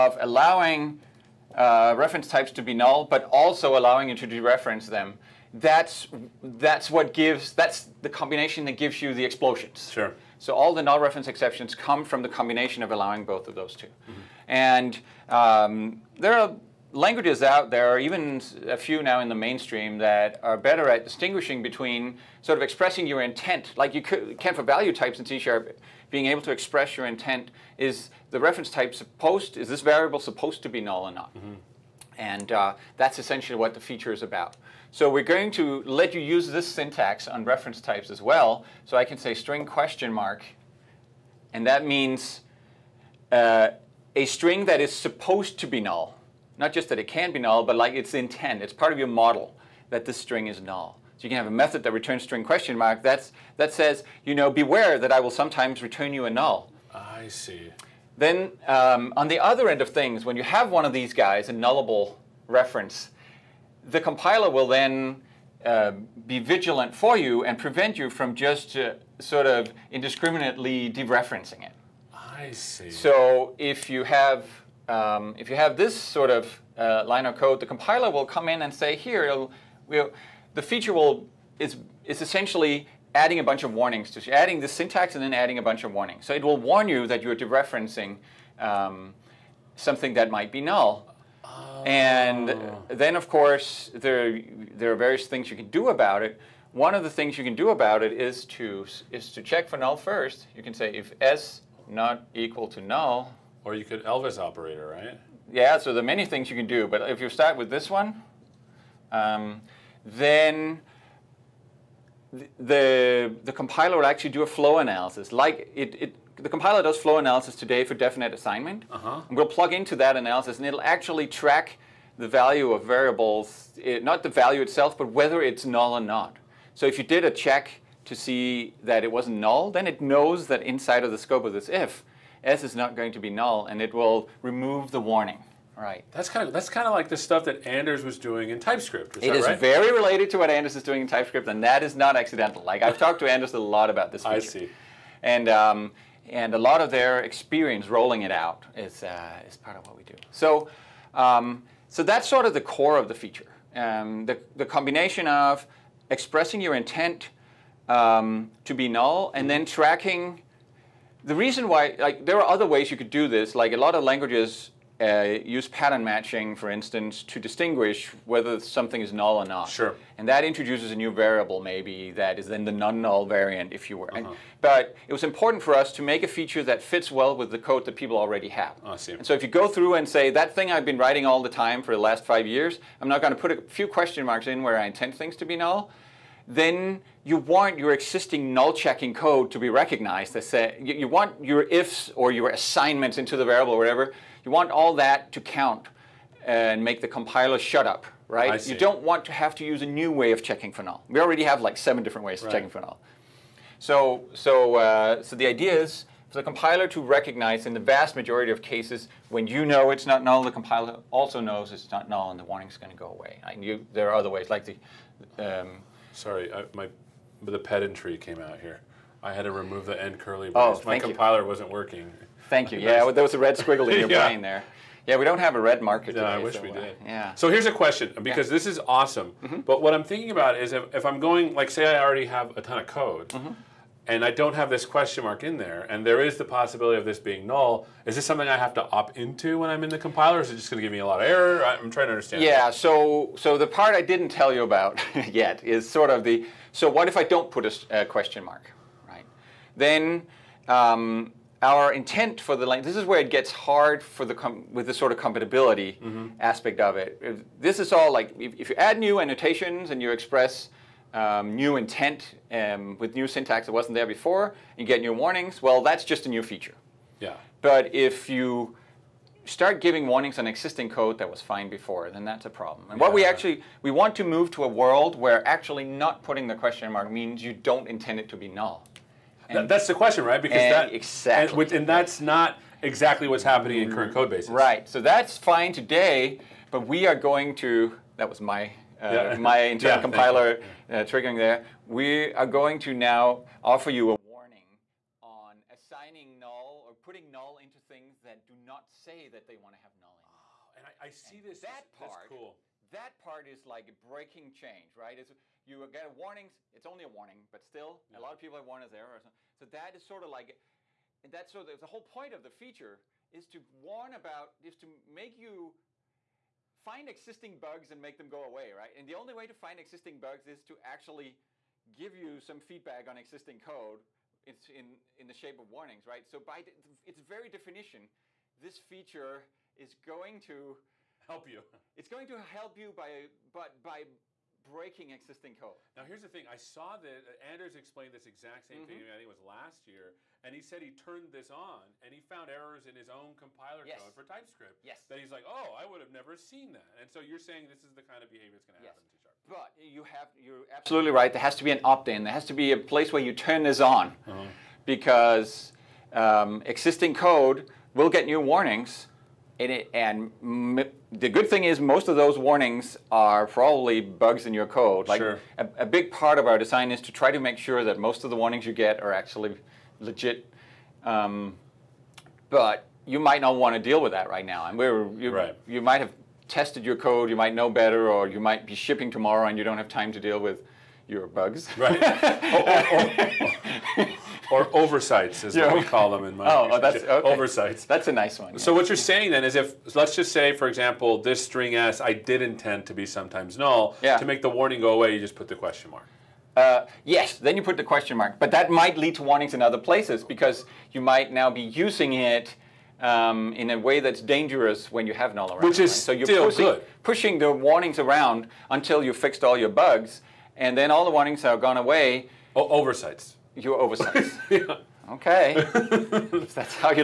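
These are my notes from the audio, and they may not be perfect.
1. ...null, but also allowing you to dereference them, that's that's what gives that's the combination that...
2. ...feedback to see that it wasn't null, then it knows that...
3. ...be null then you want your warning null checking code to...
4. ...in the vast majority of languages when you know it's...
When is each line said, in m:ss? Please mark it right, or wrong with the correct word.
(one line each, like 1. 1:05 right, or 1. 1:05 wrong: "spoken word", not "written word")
1. 0:02 right
2. 2:07 wrong: "check", not "feedback"
3. 3:05 wrong: "existing", not "warning"
4. 3:27 wrong: "cases", not "languages".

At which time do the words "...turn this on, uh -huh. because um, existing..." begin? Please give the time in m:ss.
5:53.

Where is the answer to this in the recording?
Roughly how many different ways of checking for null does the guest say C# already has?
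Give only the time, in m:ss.
3:21.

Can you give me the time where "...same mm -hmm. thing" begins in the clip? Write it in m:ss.
5:38.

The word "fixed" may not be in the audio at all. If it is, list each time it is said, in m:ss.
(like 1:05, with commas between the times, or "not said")
6:49.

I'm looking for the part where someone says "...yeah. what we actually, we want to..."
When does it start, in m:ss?
4:32.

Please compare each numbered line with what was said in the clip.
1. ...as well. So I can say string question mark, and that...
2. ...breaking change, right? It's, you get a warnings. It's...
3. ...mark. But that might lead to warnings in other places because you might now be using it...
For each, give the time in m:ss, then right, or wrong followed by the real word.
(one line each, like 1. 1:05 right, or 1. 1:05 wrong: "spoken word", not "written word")
1. 0:38 right
2. 5:03 right
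3. 6:38 right.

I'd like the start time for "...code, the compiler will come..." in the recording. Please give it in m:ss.
1:17.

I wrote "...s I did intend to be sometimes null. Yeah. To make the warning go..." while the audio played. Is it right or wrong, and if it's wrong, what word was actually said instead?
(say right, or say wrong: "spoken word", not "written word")
right.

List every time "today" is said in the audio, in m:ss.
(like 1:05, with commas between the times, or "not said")
1:57, 3:46, 4:45.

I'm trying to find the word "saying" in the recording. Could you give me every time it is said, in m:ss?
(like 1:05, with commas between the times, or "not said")
5:47, 6:28.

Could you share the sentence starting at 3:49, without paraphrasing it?
But what I'm thinking about is if, if, I'm going, like, say I already have a ton of code.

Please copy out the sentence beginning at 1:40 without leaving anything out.
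You can say if s not equal to null, or you could Elvis operator, right?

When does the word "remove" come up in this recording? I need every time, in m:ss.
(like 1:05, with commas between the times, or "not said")
2:14, 3:39.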